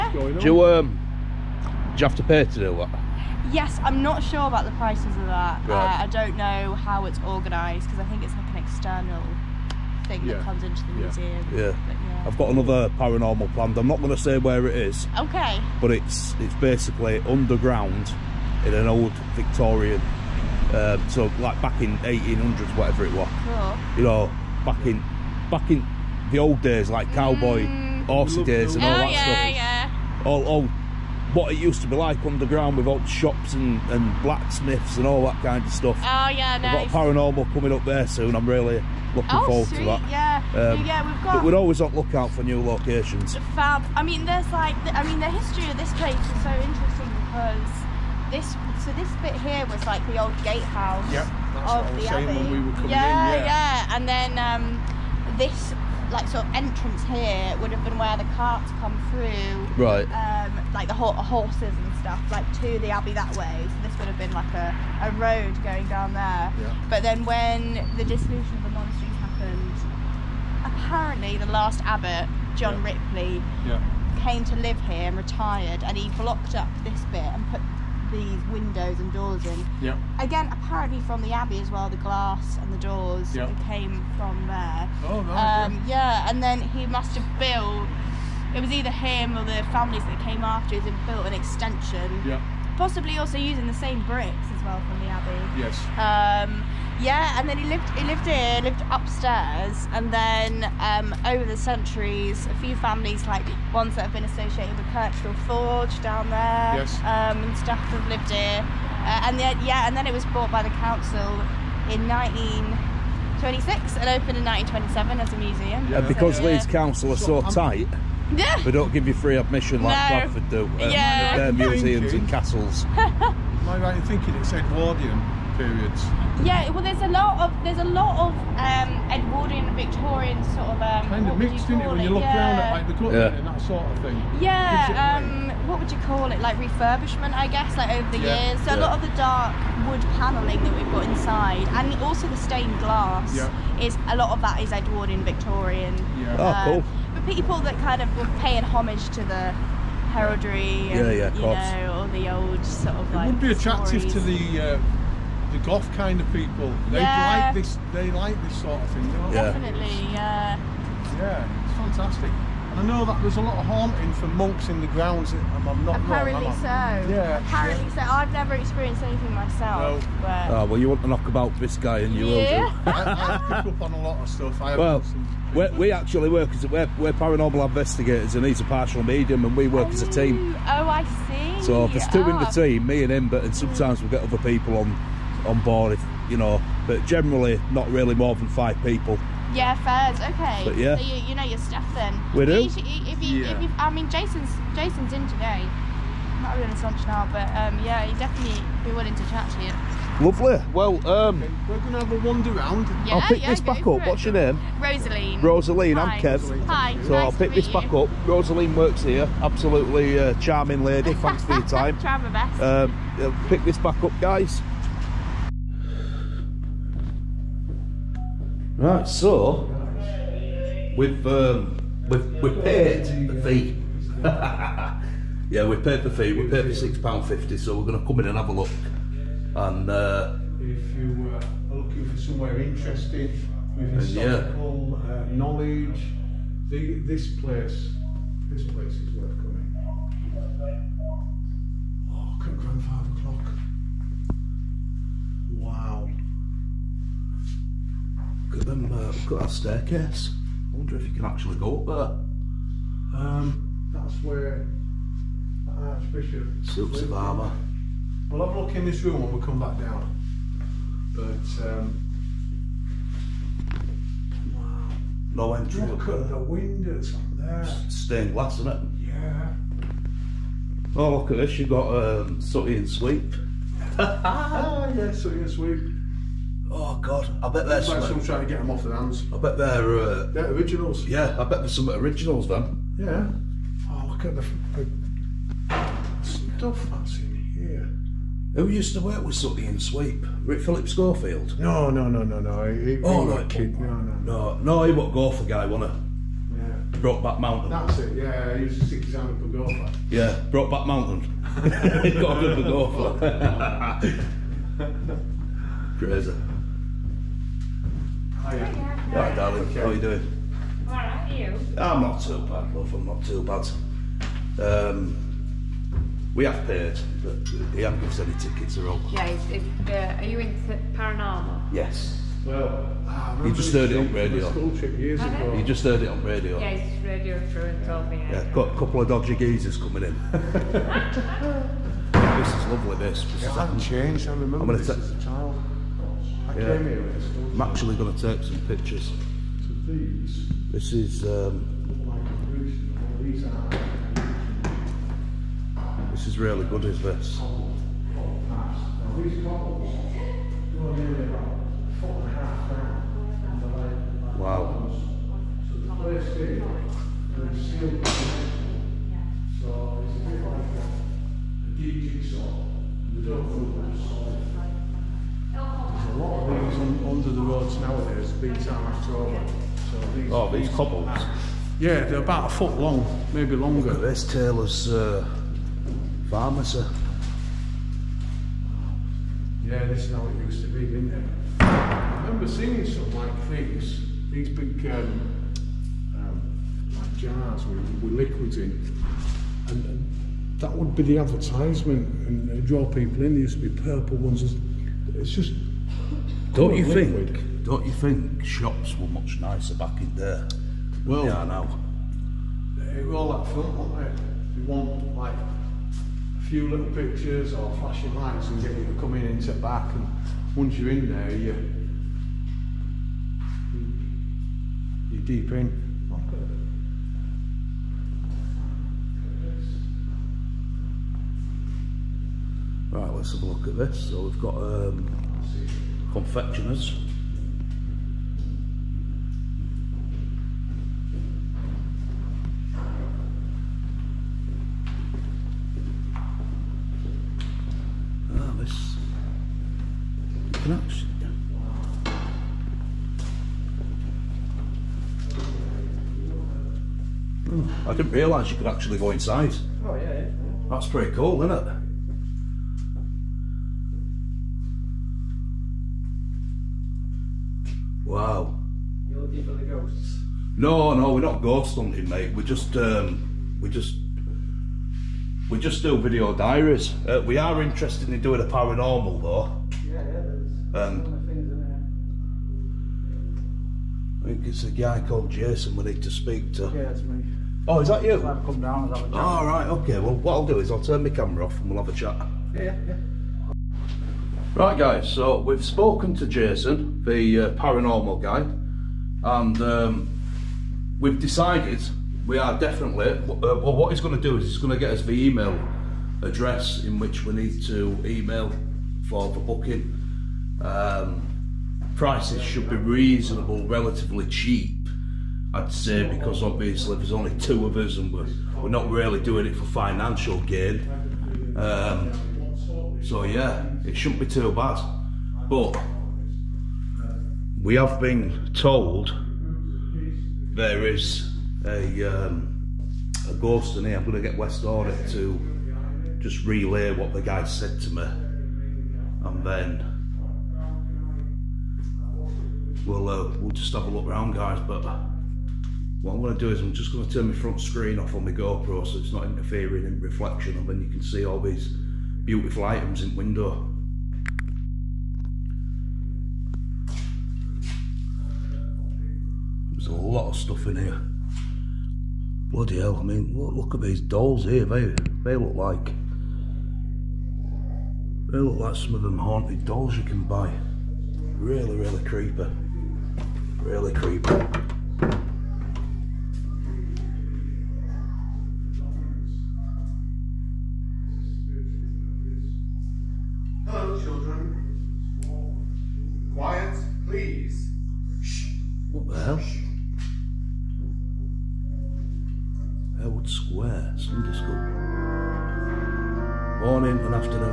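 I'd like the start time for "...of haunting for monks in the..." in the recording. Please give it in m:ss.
2:43.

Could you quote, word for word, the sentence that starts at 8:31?
Um, so yeah, it shouldn't be too bad.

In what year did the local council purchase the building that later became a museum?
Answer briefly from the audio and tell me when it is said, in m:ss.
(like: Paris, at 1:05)
1926, at 1:52.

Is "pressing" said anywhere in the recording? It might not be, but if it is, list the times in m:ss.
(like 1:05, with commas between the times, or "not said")
not said.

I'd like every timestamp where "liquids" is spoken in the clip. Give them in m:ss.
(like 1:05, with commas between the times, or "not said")
6:28, 6:36.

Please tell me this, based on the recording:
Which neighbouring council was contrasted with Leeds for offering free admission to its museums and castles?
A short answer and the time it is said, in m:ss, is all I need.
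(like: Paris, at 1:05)
Bradford, at 2:00.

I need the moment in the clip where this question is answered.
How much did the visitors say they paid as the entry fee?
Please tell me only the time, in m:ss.
3:46.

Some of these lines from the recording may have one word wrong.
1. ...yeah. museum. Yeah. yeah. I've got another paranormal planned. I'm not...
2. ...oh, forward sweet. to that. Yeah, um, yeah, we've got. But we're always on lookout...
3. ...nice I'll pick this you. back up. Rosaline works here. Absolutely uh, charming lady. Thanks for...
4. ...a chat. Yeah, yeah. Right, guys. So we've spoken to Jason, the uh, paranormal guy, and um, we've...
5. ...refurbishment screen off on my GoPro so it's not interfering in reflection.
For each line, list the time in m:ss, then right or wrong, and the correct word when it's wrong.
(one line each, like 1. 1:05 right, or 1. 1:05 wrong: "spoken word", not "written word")
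1. 0:10 right
2. 0:39 right
3. 3:26 right
4. 8:01 right
5. 8:57 wrong: "front", not "refurbishment".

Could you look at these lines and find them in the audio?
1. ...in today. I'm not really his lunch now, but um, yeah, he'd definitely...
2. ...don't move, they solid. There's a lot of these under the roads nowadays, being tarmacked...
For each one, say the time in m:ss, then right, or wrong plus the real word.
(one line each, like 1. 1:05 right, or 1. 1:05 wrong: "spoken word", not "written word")
1. 3:15 right
2. 6:03 right.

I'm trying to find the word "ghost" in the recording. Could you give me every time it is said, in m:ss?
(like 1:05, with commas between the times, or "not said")
7:41, 8:43.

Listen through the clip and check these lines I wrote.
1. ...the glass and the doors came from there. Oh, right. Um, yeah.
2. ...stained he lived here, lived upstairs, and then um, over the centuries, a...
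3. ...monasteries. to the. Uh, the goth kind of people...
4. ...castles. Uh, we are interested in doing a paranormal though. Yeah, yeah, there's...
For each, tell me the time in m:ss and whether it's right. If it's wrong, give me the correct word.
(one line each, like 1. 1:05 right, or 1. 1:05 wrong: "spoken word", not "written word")
1. 1:21 right
2. 1:37 wrong: "lived", not "stained"
3. 2:34 wrong: "stories", not "monasteries"
4. 7:46 wrong: "diaries", not "castles".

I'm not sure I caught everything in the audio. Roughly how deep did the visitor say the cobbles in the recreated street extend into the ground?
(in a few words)
a foot and a half.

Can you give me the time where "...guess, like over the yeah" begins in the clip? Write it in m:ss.
2:17.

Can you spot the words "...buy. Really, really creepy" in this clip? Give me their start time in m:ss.
9:20.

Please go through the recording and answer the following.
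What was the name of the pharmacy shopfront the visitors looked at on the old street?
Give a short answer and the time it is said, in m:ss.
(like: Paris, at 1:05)
Taylor's, at 6:14.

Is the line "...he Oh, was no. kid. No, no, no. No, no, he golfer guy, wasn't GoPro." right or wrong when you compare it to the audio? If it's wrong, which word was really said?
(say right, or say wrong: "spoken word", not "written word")
wrong: "Yeah", not "GoPro".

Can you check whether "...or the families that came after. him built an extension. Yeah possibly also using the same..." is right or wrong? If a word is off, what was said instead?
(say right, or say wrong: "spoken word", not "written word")
right.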